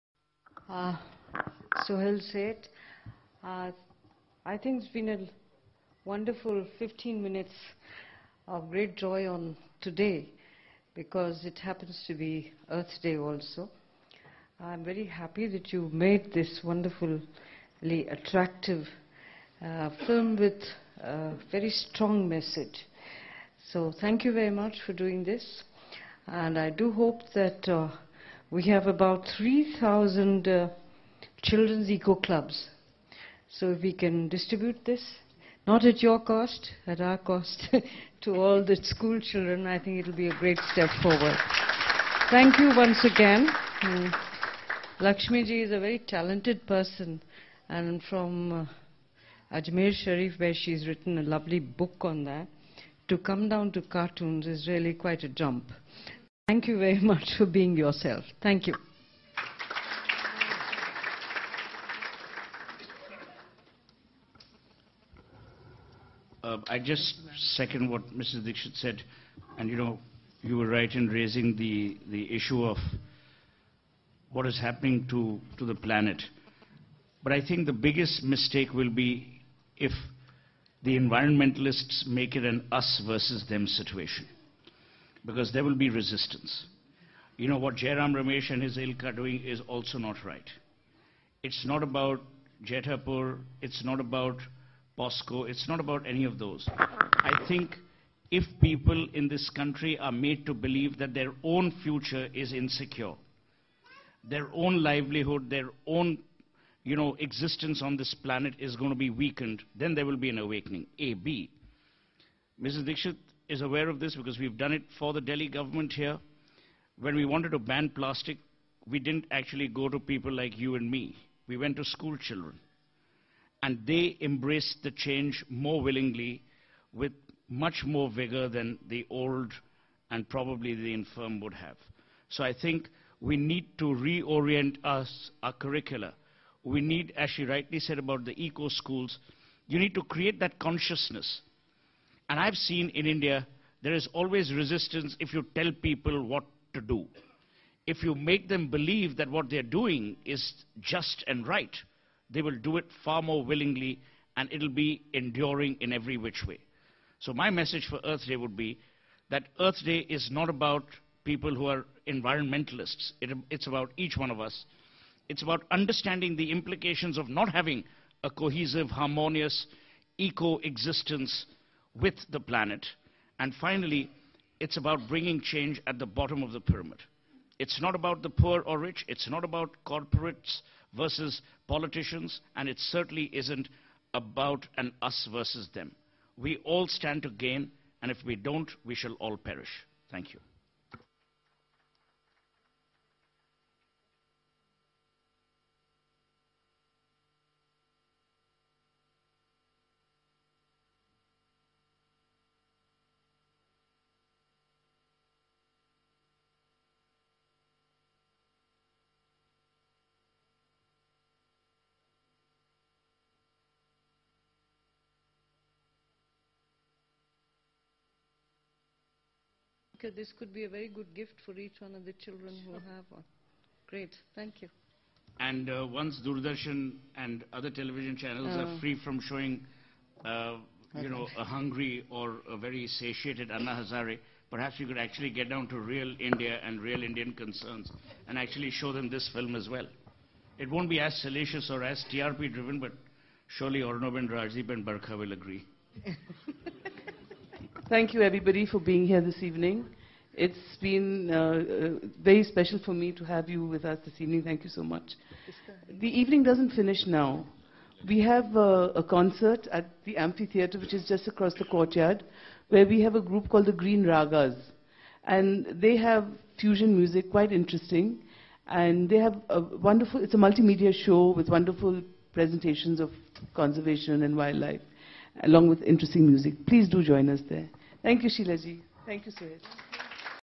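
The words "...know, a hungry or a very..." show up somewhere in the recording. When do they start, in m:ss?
3:51.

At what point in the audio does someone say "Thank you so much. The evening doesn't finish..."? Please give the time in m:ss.
4:14.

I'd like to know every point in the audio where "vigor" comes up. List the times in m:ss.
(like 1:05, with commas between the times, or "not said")
2:08.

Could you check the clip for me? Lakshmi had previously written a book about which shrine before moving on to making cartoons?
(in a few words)
Ajmer Sharif.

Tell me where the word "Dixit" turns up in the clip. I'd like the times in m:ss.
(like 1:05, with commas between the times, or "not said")
1:08, 1:52.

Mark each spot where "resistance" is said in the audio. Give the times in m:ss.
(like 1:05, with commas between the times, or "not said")
1:25, 2:24.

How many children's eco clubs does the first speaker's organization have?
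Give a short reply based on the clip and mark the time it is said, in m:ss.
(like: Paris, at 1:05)
3,000, at 0:29.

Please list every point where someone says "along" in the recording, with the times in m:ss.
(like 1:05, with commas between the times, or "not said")
4:35.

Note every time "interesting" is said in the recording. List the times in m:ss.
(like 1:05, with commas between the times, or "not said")
4:27, 4:35.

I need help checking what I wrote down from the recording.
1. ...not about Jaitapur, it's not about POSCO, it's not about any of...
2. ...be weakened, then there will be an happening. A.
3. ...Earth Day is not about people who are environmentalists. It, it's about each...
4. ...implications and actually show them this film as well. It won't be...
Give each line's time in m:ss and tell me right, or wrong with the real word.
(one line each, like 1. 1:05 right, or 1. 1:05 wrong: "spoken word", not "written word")
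1. 1:31 right
2. 1:48 wrong: "awakening", not "happening"
3. 2:39 right
4. 3:57 wrong: "concerns", not "implications".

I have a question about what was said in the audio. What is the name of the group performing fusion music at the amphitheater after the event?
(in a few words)
Green Ragas.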